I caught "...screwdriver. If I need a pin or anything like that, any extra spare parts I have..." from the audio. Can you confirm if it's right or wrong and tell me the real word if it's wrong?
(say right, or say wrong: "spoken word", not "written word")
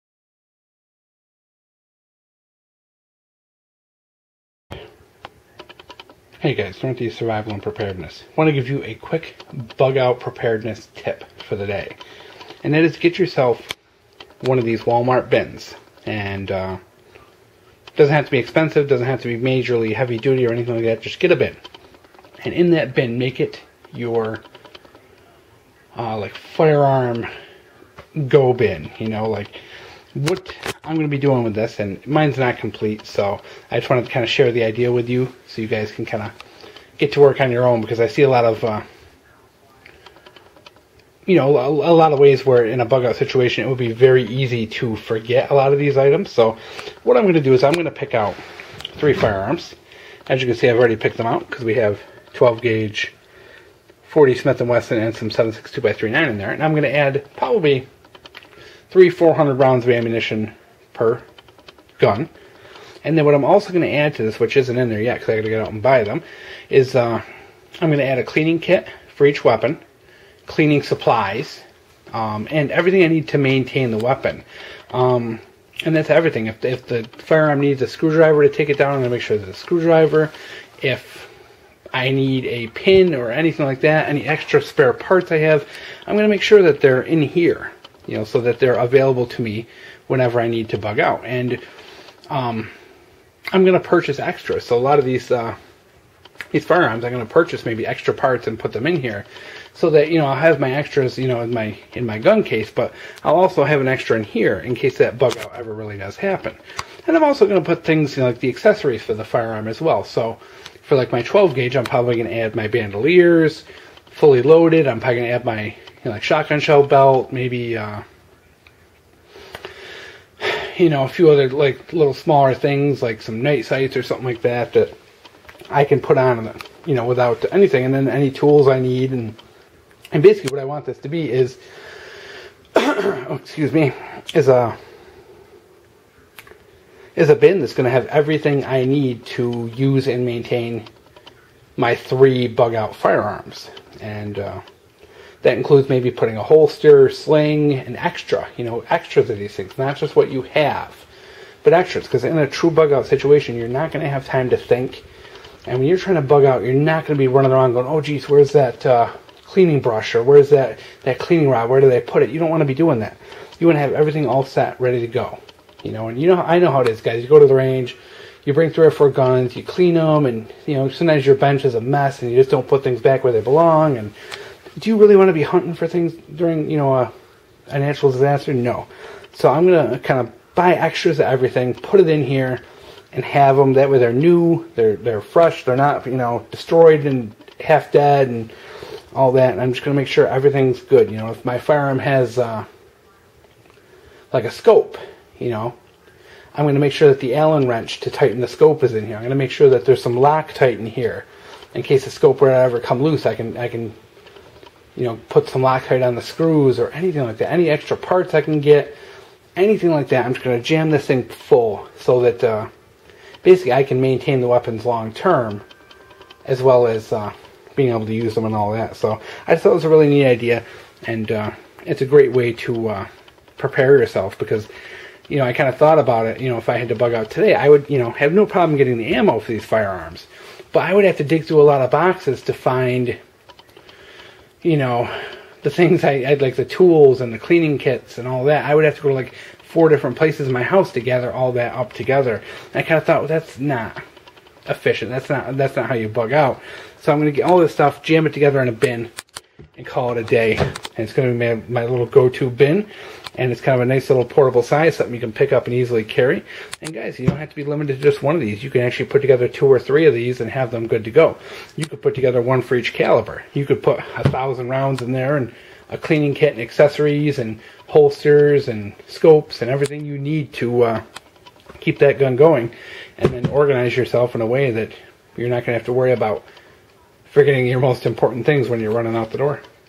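right.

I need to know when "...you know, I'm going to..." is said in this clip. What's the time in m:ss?
3:15.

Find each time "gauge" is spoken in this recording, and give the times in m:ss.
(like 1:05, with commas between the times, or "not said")
0:52, 1:51.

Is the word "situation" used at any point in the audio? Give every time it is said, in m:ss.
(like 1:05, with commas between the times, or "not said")
0:43, 2:33.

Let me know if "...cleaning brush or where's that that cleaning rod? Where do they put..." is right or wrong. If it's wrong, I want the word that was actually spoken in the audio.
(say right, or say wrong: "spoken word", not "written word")
right.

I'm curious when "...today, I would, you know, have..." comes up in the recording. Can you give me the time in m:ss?
3:47.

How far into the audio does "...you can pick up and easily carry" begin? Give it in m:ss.
4:15.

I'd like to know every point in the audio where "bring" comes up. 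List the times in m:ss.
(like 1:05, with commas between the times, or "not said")
2:48.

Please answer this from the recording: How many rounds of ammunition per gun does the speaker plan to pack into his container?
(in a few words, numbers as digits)
300-400.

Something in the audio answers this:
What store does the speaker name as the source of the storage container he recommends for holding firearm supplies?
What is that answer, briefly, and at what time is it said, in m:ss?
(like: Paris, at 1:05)
Walmart, at 0:14.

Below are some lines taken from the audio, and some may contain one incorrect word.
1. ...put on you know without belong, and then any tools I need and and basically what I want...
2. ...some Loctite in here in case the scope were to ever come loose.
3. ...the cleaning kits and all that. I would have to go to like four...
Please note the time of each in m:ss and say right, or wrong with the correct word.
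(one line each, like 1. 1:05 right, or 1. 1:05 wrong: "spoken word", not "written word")
1. 2:05 wrong: "anything", not "belong"
2. 3:20 right
3. 3:57 right.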